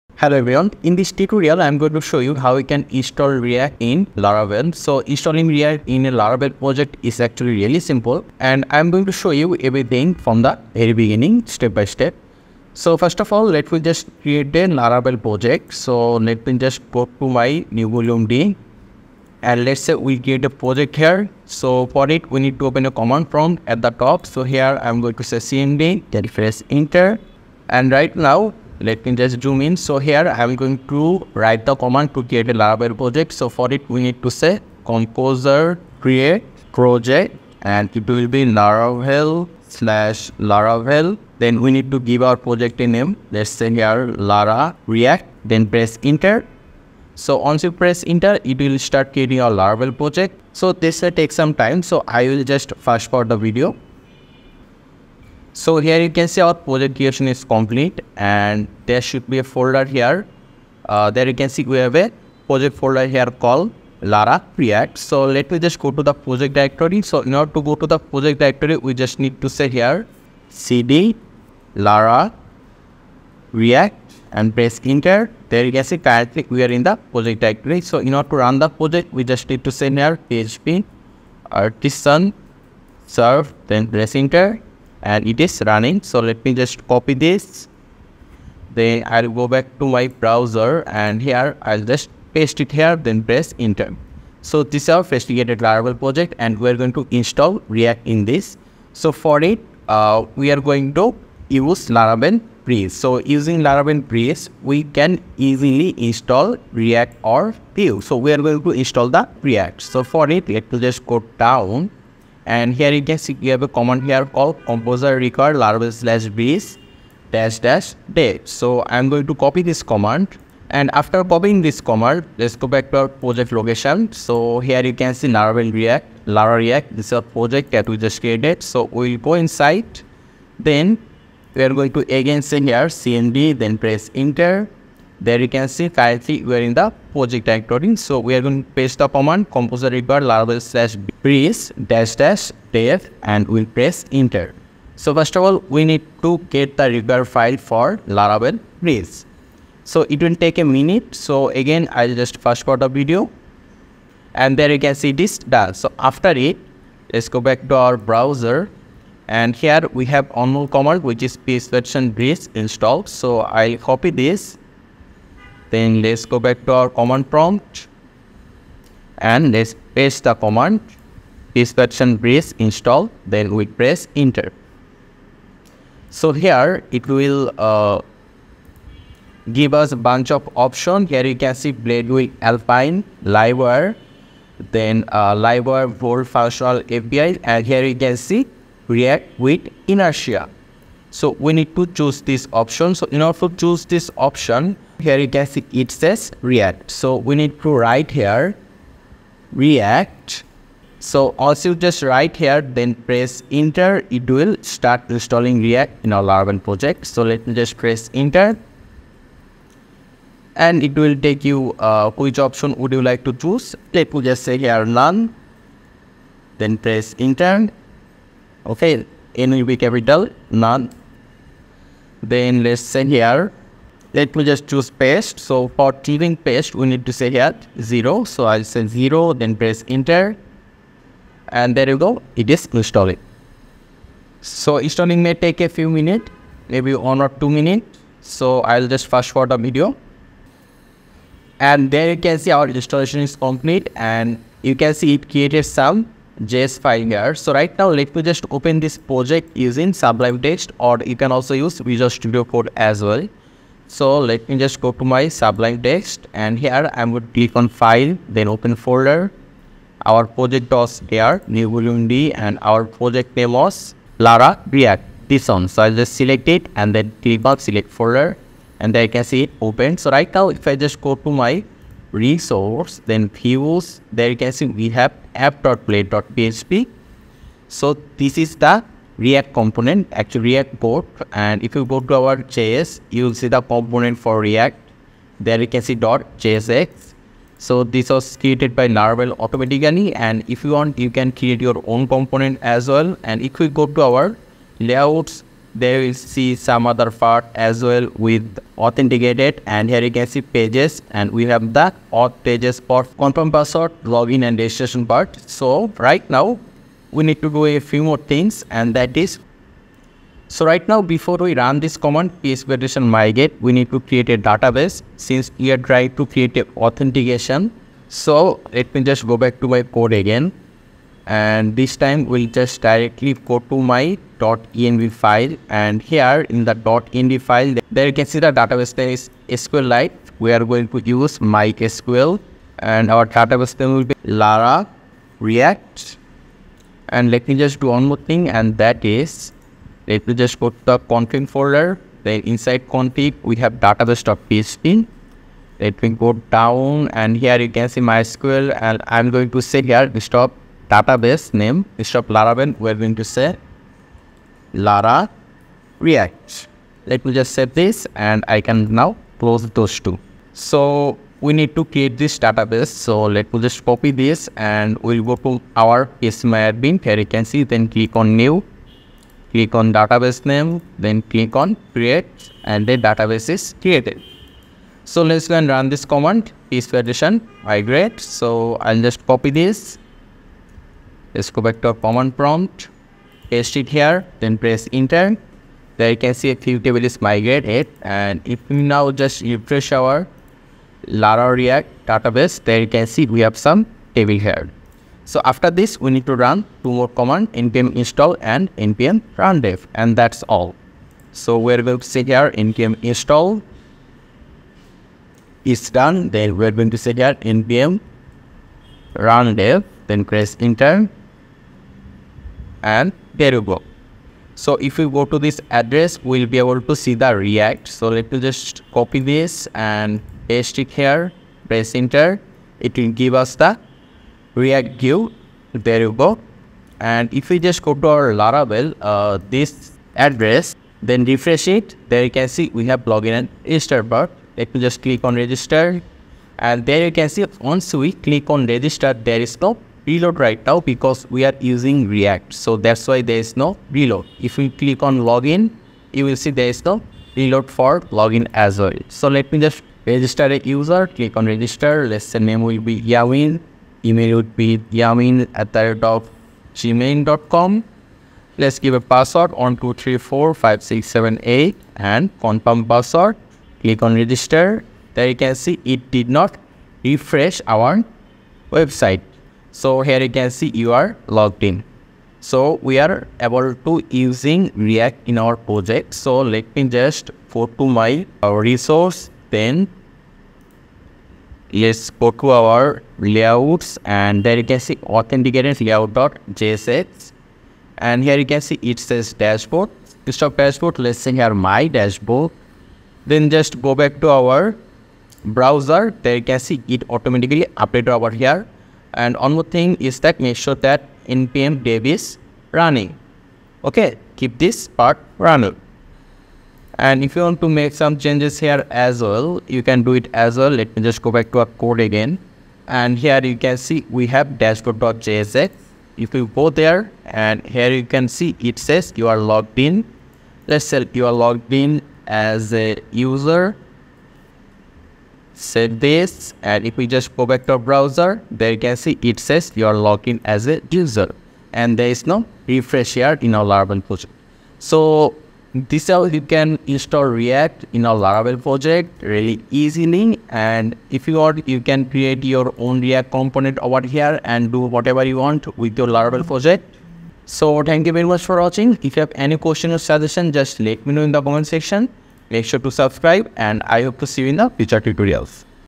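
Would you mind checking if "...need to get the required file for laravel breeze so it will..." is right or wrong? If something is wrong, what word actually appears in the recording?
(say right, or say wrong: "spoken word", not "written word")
right.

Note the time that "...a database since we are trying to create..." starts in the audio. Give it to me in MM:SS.
05:14.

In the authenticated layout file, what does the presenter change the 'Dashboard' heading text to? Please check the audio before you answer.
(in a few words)
My Dashboard.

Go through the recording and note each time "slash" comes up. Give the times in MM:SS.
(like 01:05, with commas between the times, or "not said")
00:39, 01:55, 02:20.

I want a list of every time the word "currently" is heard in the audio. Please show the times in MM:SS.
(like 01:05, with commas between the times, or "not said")
01:15, 02:15.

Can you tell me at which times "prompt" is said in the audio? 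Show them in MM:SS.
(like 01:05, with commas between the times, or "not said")
00:23, 02:47, 06:22.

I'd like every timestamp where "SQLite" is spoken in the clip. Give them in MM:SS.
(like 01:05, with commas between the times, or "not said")
05:29.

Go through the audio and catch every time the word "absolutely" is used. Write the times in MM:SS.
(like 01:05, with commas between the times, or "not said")
not said.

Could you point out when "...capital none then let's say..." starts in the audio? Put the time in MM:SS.
03:39.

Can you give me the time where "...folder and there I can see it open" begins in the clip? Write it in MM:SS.
04:27.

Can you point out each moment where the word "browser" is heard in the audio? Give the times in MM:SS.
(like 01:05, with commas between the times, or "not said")
01:30, 02:37, 08:15, 08:47.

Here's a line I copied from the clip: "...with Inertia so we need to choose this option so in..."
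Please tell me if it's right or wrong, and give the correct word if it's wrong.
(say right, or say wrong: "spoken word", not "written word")
right.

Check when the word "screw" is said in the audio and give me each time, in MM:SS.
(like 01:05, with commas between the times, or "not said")
not said.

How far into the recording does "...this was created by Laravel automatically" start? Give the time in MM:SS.
04:47.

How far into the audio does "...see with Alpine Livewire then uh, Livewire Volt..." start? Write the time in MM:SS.
03:01.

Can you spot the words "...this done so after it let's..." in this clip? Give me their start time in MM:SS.
02:35.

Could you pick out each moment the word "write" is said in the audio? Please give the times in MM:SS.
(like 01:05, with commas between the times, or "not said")
00:31, 03:17, 03:22.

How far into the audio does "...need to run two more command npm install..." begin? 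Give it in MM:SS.
06:36.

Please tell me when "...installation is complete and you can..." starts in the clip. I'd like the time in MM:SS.
04:02.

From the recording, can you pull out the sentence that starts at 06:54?
So if we go to this address, we'll be able to see the React.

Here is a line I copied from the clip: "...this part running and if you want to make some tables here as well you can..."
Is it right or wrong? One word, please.
wrong.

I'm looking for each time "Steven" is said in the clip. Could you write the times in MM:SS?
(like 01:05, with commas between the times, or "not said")
not said.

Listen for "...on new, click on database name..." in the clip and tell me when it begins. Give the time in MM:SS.
06:08.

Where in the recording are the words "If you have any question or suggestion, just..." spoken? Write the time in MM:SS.
09:09.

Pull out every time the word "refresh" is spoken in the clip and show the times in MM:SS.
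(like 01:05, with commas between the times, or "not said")
06:29, 07:11, 07:47, 08:52.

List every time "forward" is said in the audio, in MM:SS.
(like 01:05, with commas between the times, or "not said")
00:53, 02:32, 03:59.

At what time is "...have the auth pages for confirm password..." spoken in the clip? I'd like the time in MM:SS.
05:01.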